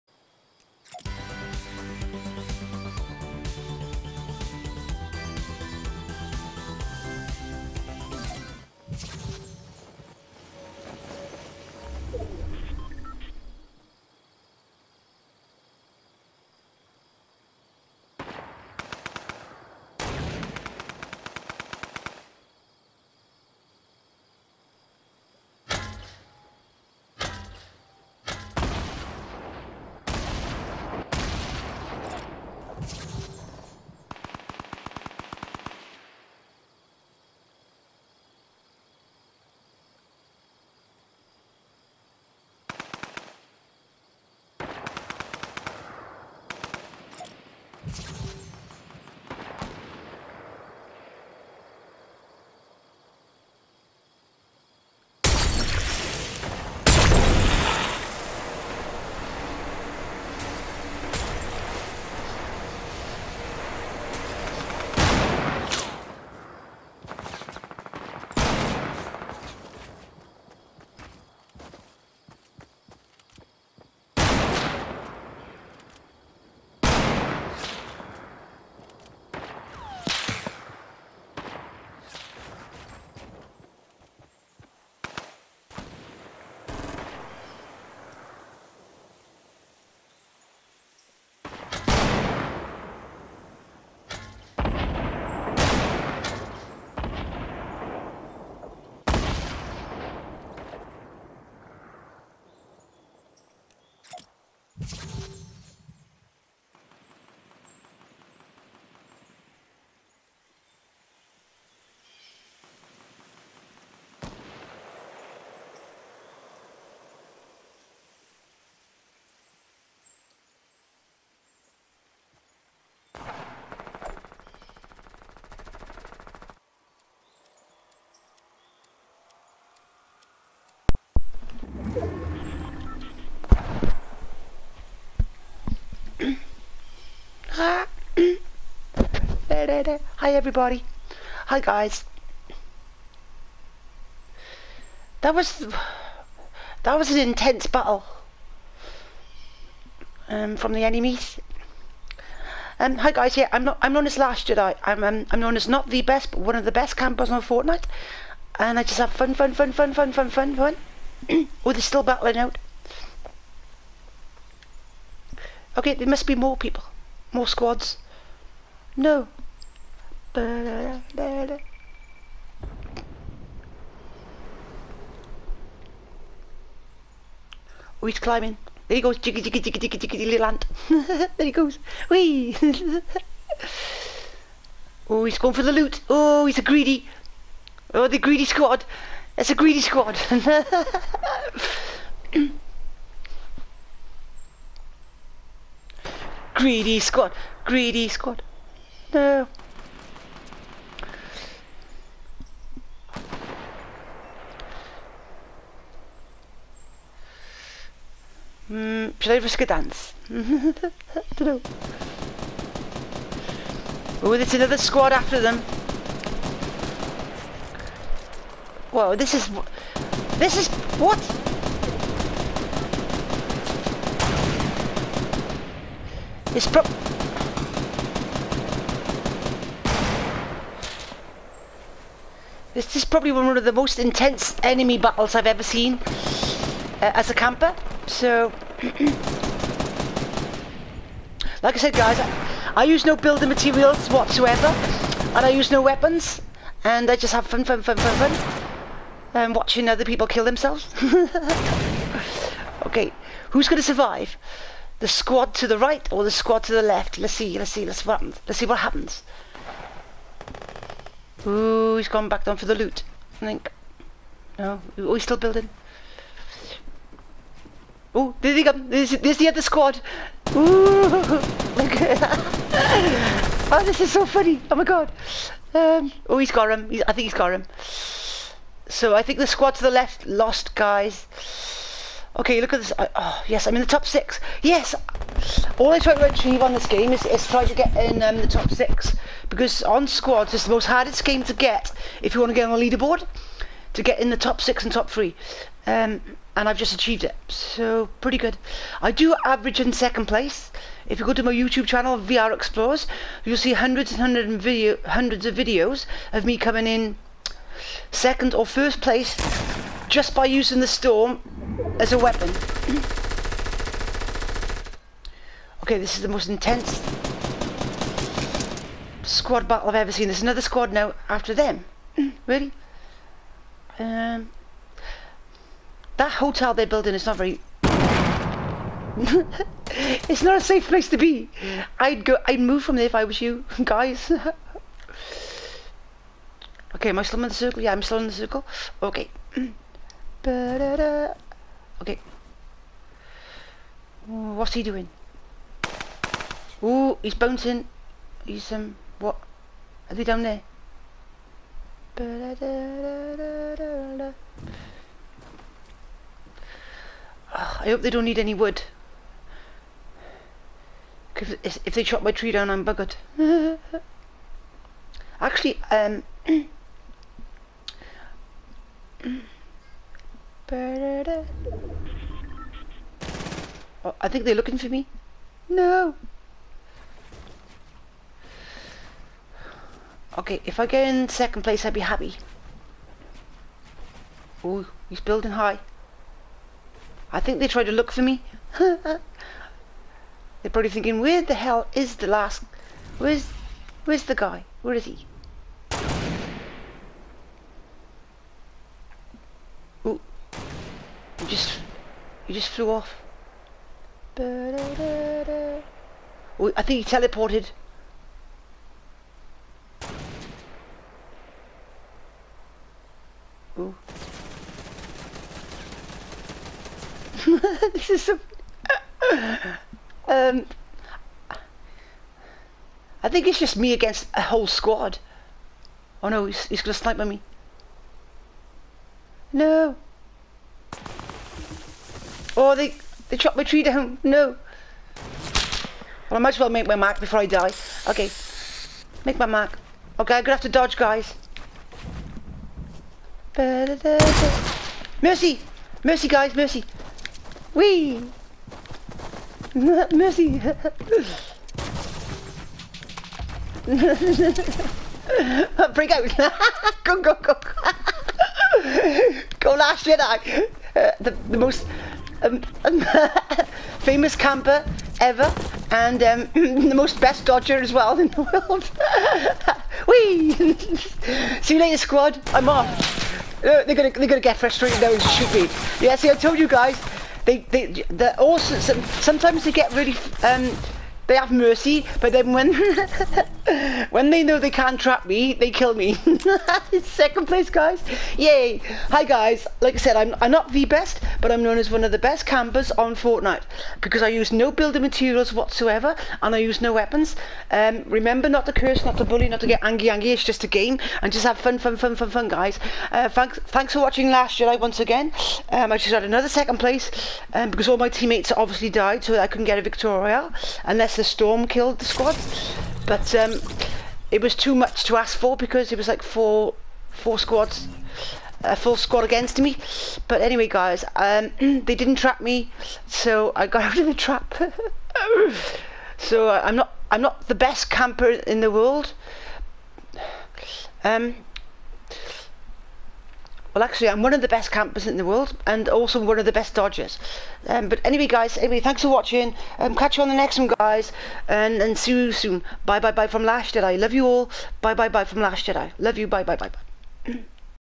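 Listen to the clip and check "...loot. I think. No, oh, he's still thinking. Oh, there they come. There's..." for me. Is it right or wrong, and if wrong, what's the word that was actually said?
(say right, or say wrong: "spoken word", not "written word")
wrong: "building", not "thinking".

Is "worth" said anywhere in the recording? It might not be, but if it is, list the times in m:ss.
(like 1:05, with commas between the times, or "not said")
not said.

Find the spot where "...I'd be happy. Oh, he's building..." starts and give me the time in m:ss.
6:21.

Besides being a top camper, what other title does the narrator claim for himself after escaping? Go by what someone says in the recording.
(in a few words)
Best dodger.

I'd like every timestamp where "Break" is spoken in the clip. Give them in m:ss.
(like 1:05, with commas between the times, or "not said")
7:35.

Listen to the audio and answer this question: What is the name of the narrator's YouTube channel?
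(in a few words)
VR Explorers.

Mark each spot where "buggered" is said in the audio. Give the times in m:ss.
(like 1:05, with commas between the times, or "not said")
6:02.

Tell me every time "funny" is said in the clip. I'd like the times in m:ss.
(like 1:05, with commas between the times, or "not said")
4:34.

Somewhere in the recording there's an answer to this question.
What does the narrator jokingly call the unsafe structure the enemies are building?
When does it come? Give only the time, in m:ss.
5:26.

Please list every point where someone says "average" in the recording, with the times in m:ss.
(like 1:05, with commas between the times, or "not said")
4:59.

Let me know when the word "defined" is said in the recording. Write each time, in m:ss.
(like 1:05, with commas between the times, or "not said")
not said.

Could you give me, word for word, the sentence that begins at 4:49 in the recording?
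Because on squads, it's the most hardest game to get if you want to get on the leaderboard.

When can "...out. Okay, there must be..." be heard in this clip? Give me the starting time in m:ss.
2:42.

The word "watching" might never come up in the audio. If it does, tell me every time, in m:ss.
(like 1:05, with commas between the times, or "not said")
4:09, 8:24, 8:59.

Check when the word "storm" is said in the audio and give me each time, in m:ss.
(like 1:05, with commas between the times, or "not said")
5:10, 8:31.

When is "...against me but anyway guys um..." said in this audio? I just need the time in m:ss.
8:39.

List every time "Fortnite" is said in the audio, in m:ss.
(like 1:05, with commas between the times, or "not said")
2:37, 8:13.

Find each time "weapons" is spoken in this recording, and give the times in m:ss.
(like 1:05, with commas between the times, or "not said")
4:05, 5:12, 8:16.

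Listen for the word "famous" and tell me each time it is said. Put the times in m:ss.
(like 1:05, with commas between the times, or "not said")
7:43.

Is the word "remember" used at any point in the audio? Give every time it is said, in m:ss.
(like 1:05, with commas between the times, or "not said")
8:18.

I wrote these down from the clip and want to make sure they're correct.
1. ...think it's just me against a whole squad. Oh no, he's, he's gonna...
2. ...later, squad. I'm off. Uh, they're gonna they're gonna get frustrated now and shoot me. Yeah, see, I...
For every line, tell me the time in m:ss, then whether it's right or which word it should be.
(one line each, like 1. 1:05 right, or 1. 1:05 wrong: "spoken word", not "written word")
1. 7:03 right
2. 7:51 right.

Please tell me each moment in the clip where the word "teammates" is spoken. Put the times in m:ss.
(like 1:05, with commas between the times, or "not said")
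8:28.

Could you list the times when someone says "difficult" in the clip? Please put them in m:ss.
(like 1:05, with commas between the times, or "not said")
not said.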